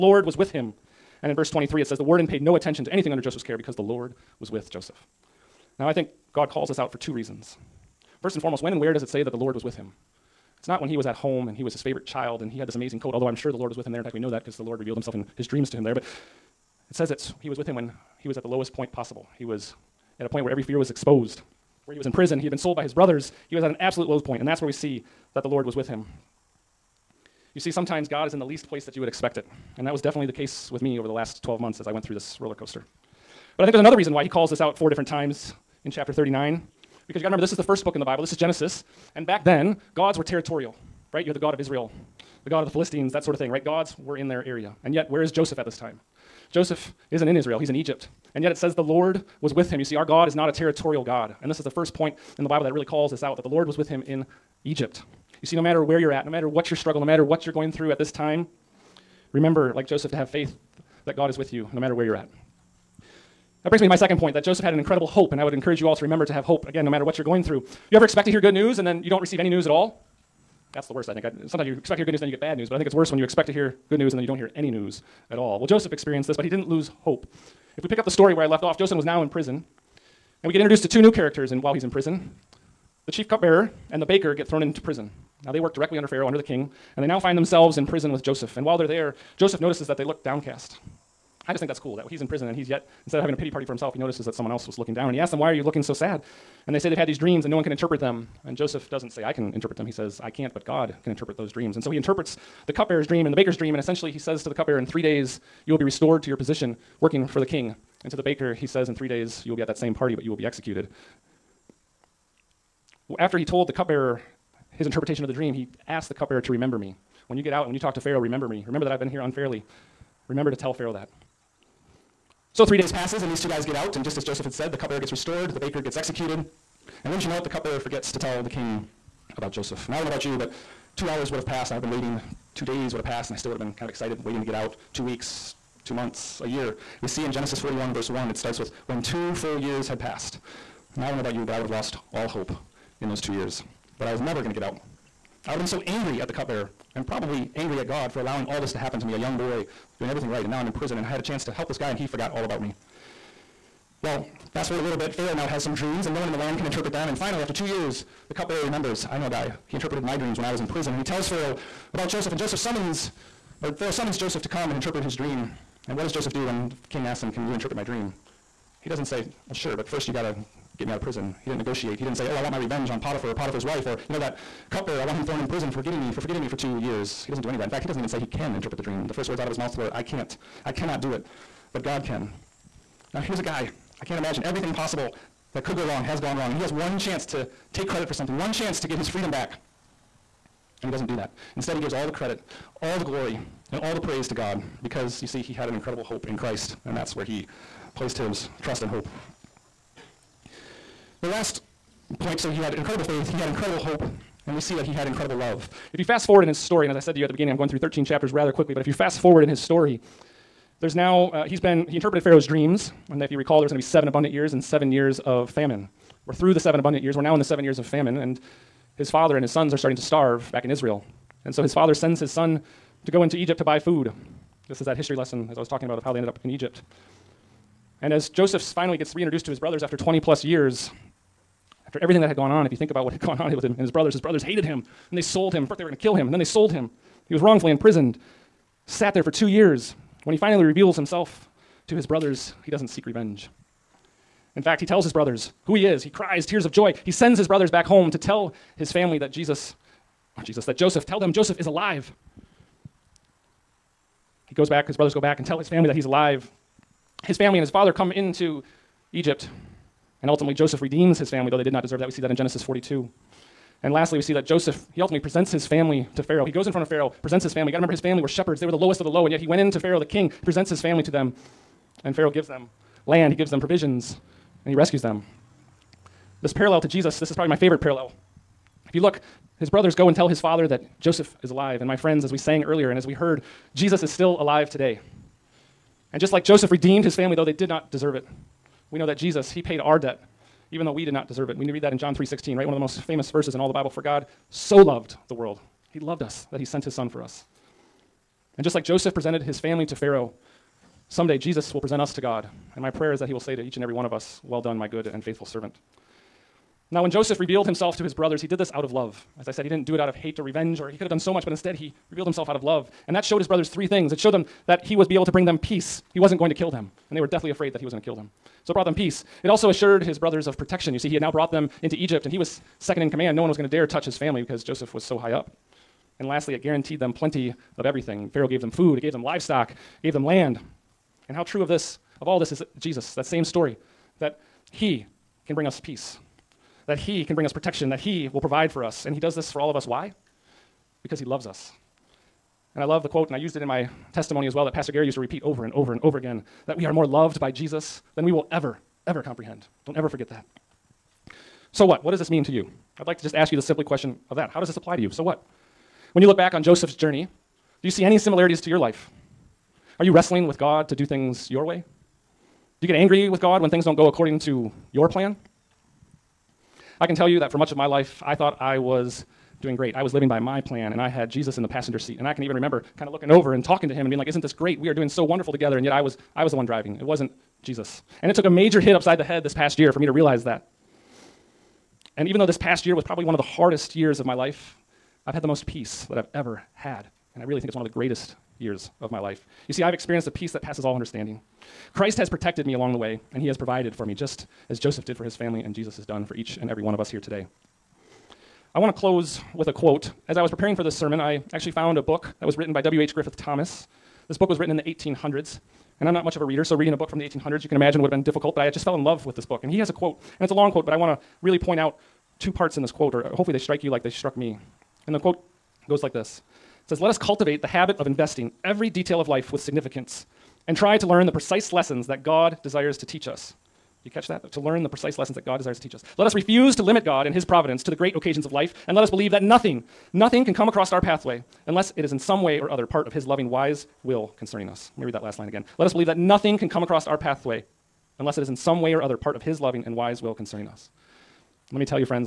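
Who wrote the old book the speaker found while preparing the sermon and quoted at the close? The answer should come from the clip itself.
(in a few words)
W.H. Griffith Thomas.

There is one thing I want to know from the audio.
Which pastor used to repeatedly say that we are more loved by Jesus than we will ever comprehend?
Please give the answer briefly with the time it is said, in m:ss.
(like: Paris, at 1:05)
Pastor Gary, at 5:44.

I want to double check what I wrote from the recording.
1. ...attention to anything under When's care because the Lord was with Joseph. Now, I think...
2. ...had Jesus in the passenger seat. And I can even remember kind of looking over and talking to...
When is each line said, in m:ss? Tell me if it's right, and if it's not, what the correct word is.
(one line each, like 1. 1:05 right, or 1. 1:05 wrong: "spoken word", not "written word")
1. 0:02 wrong: "Joseph", not "When"
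2. 6:11 right.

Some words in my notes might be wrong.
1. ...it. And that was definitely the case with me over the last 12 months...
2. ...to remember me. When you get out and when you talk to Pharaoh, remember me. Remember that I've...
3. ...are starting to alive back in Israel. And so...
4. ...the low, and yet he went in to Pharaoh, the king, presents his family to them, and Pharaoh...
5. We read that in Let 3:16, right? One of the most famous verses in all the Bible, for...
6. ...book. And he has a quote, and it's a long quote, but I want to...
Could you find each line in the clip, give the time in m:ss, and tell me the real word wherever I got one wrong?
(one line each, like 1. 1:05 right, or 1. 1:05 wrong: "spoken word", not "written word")
1. 0:29 right
2. 1:56 right
3. 3:39 wrong: "starve", not "alive"
4. 4:29 right
5. 4:51 wrong: "John", not "Let"
6. 6:49 right.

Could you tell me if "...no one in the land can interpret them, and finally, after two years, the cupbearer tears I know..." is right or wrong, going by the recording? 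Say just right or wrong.
wrong.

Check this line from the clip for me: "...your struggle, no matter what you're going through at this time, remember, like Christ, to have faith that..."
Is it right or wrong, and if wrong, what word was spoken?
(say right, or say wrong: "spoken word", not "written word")
wrong: "Joseph", not "Christ".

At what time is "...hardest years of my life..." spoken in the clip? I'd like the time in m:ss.
6:23.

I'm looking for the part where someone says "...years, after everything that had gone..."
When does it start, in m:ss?
3:50.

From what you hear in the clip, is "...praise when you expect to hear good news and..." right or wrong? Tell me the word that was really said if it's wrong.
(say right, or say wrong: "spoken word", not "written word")
wrong: "worse", not "praise".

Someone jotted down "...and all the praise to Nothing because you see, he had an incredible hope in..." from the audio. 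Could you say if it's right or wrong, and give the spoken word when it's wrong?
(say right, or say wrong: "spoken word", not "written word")
wrong: "God", not "Nothing".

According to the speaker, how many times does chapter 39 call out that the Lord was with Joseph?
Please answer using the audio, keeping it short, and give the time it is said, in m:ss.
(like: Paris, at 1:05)
4, at 0:34.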